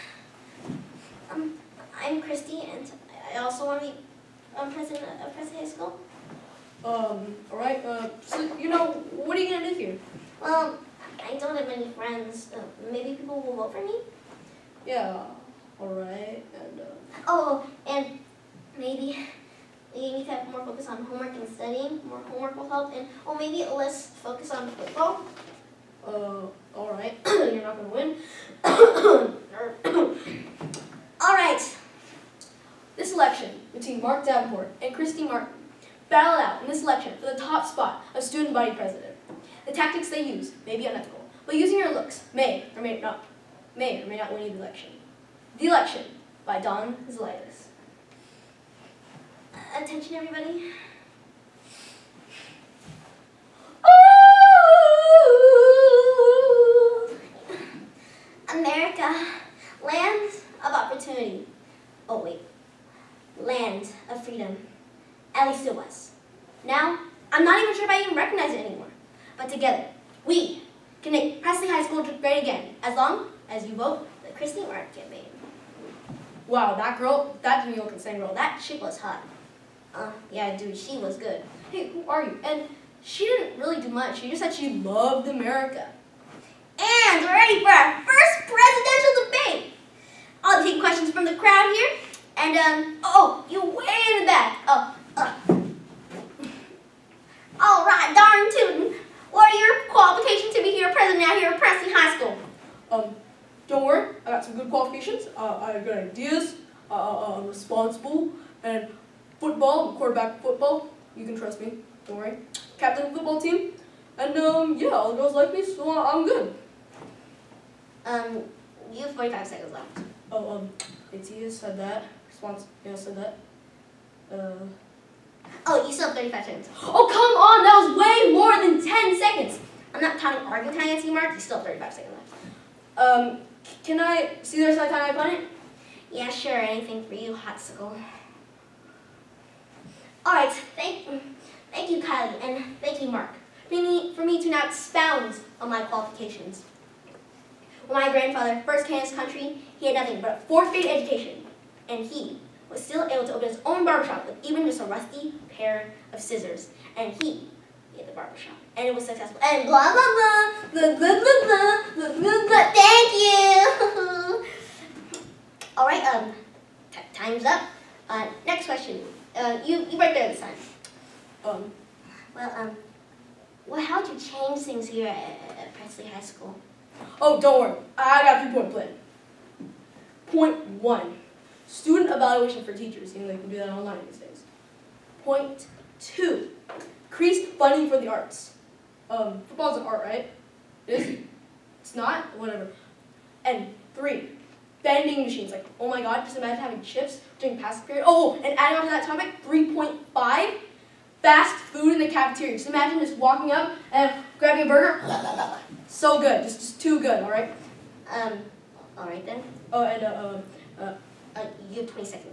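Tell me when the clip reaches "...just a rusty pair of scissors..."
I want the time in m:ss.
2:34.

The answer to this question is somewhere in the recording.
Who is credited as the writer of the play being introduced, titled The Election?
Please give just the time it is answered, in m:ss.
0:46.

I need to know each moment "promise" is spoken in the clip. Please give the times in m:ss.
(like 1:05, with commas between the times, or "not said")
not said.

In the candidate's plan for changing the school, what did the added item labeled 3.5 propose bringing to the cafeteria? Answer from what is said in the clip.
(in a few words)
fast food.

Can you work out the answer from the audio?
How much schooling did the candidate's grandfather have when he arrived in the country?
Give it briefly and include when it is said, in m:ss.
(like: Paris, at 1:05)
fourth-grade education, at 2:30.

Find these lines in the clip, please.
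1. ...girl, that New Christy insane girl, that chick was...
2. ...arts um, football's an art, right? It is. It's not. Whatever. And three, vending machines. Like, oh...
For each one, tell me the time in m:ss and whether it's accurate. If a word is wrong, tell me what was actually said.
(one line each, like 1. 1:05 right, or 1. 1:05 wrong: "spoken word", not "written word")
1. 1:16 wrong: "York", not "Christy"
2. 3:08 right.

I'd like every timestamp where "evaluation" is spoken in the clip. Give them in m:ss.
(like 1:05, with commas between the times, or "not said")
3:02.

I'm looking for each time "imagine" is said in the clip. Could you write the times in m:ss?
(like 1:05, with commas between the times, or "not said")
3:16, 3:22.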